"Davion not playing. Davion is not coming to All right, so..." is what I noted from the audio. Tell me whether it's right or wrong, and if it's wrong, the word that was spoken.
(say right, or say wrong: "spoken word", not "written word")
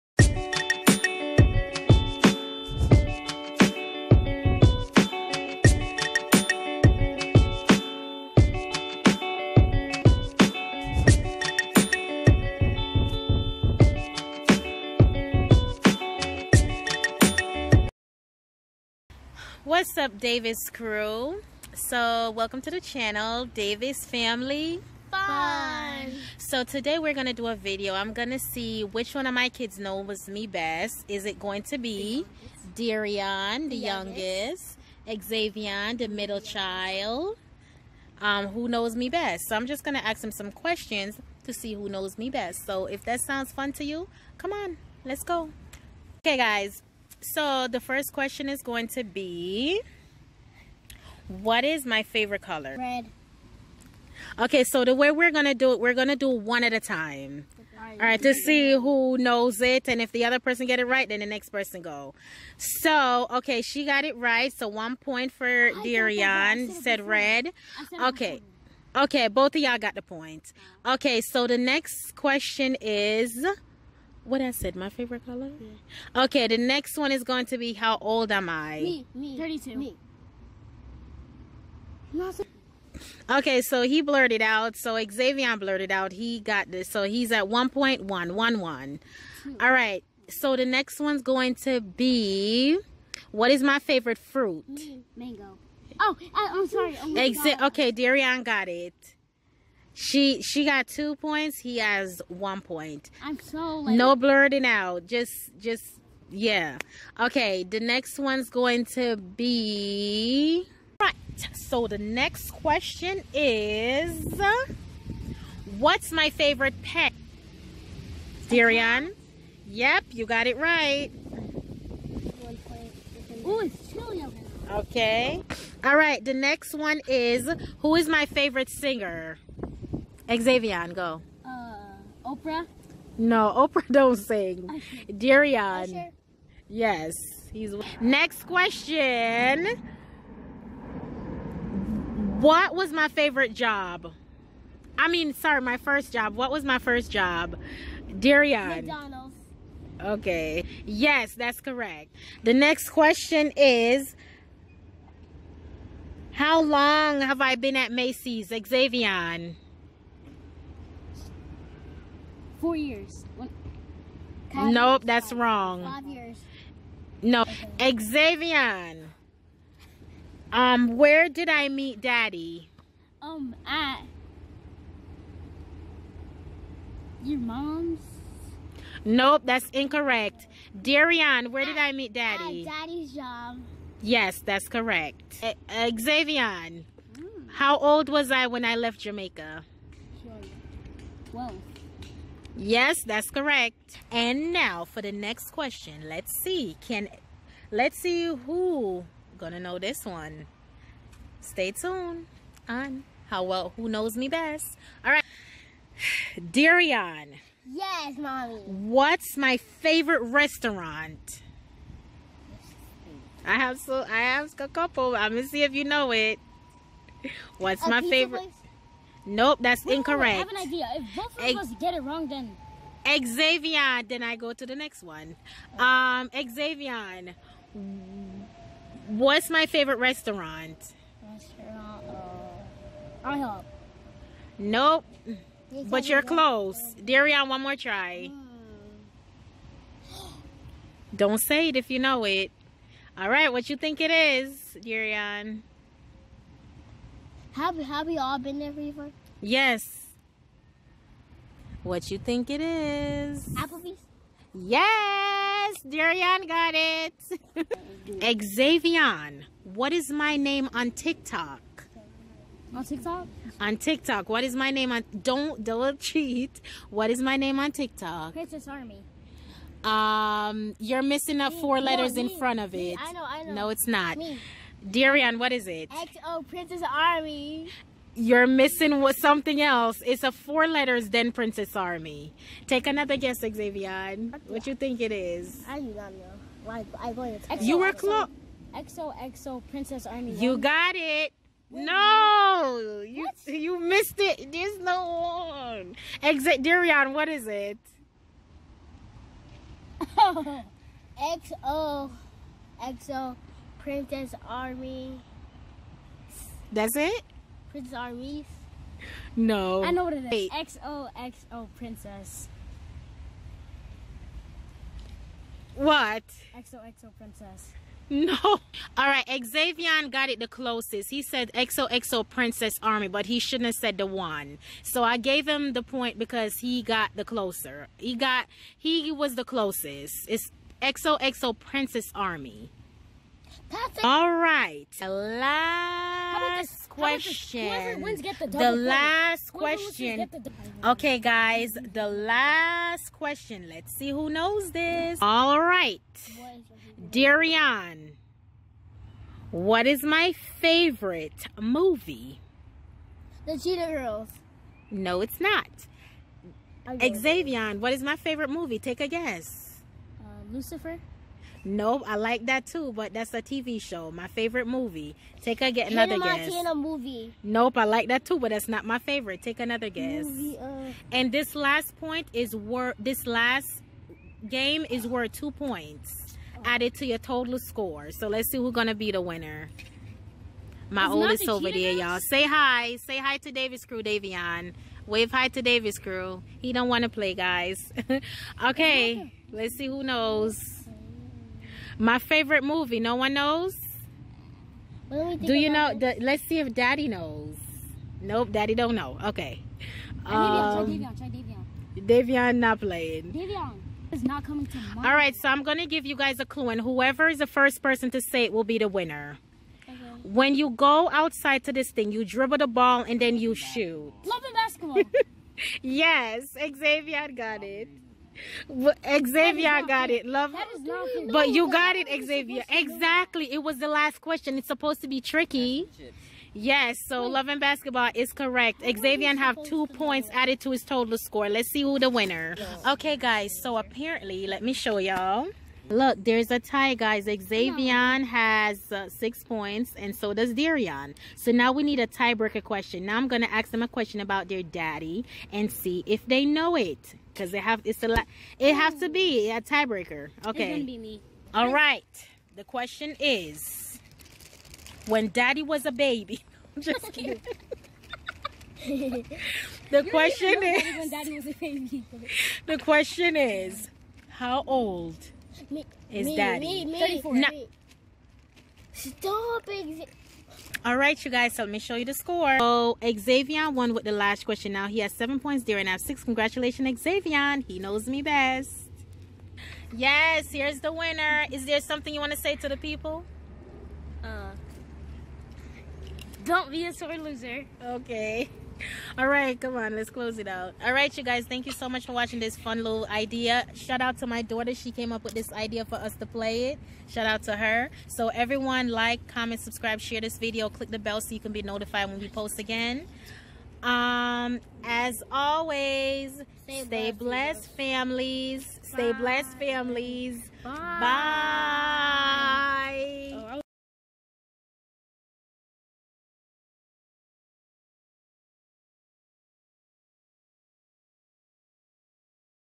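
right.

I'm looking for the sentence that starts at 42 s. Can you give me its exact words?
So if that sounds fun to you, come on, let's go.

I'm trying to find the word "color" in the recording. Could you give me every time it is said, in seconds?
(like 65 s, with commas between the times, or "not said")
52 s, 75 s.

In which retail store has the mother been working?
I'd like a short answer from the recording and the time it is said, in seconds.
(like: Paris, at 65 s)
Macy's, at 157 s.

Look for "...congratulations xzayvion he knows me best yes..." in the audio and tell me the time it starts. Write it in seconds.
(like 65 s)
476 s.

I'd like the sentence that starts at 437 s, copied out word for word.
Xzayvion has uh, six points, and so does Dereion.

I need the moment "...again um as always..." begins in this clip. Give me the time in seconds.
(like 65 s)
502 s.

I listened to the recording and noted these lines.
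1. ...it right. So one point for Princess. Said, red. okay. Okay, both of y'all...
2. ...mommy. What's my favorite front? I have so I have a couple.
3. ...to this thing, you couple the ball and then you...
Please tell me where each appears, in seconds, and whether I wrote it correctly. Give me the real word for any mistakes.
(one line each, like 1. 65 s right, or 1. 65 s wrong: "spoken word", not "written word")
1. 64 s wrong: "Dereion", not "Princess"
2. 208 s wrong: "restaurant", not "front"
3. 411 s wrong: "dribble", not "couple".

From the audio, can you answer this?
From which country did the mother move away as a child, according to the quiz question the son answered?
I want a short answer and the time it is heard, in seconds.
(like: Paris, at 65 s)
Jamaica, at 188 s.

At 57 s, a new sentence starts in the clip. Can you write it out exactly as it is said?
All right, to see who knows it.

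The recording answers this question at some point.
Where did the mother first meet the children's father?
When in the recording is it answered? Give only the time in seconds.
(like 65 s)
182 s.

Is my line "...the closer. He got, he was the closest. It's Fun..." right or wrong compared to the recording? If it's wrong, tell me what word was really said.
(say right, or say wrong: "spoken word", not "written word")
wrong: "XOXO", not "Fun".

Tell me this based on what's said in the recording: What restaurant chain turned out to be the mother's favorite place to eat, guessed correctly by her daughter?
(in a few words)
Applebee's.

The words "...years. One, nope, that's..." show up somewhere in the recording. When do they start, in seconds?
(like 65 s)
162 s.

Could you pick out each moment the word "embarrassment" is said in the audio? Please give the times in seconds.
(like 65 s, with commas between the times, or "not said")
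not said.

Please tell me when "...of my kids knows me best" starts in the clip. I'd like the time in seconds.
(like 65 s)
29 s.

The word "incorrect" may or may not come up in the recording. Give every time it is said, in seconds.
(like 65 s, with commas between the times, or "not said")
179 s, 219 s.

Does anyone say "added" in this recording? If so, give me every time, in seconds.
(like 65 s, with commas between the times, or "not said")
376 s, 430 s.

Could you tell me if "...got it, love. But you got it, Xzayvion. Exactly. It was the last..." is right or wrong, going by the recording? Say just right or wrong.
right.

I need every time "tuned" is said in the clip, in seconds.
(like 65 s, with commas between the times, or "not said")
201 s.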